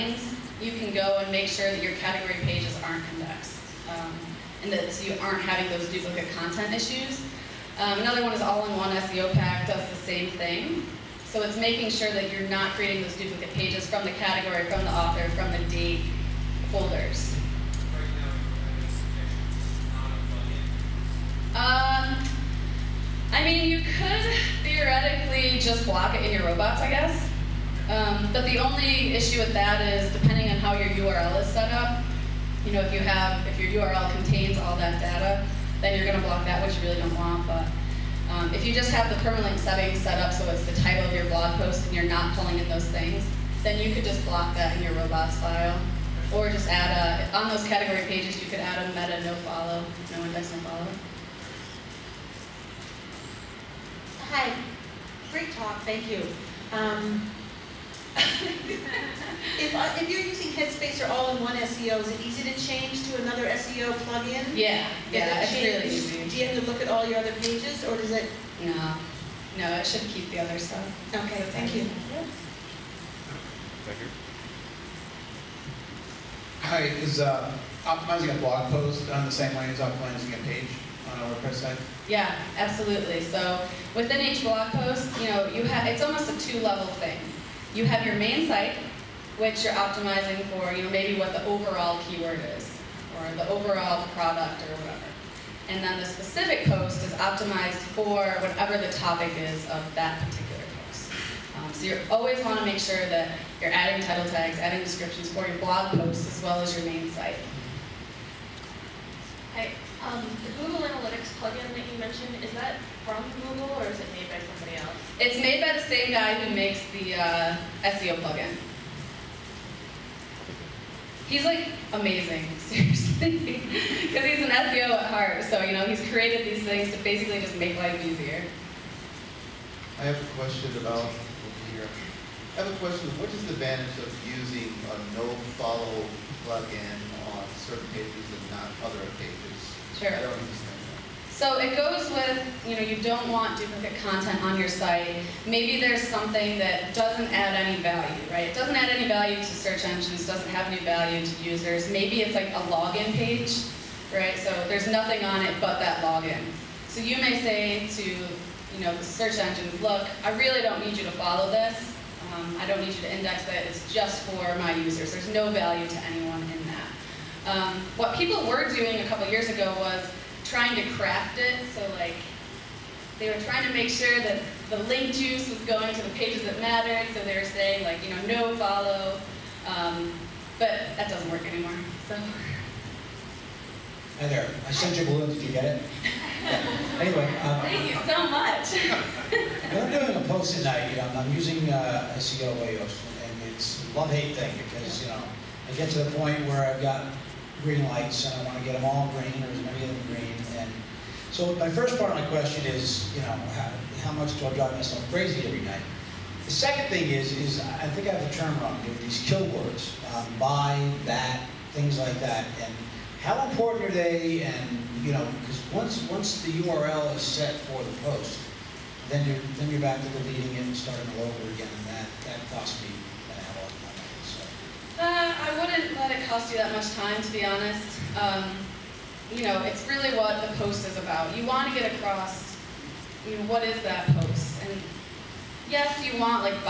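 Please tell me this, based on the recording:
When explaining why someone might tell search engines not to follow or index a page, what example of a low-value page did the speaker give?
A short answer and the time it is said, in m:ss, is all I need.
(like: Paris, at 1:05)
a login page, at 2:32.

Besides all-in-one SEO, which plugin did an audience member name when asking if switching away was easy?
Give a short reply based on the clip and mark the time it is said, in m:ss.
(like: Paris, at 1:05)
Headspace, at 1:00.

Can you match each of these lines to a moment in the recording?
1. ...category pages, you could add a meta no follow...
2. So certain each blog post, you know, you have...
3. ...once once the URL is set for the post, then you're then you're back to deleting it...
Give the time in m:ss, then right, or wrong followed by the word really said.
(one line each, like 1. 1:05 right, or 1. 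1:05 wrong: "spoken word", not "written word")
1. 0:47 right
2. 1:23 wrong: "within", not "certain"
3. 3:35 right.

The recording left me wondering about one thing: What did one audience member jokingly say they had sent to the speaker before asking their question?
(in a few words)
a balloon.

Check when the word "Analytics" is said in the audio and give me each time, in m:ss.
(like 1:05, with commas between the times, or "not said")
1:50.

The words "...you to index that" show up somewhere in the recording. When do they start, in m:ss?
2:42.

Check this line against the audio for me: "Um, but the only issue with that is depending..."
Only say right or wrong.
right.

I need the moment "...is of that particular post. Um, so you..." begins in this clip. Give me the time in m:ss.
1:39.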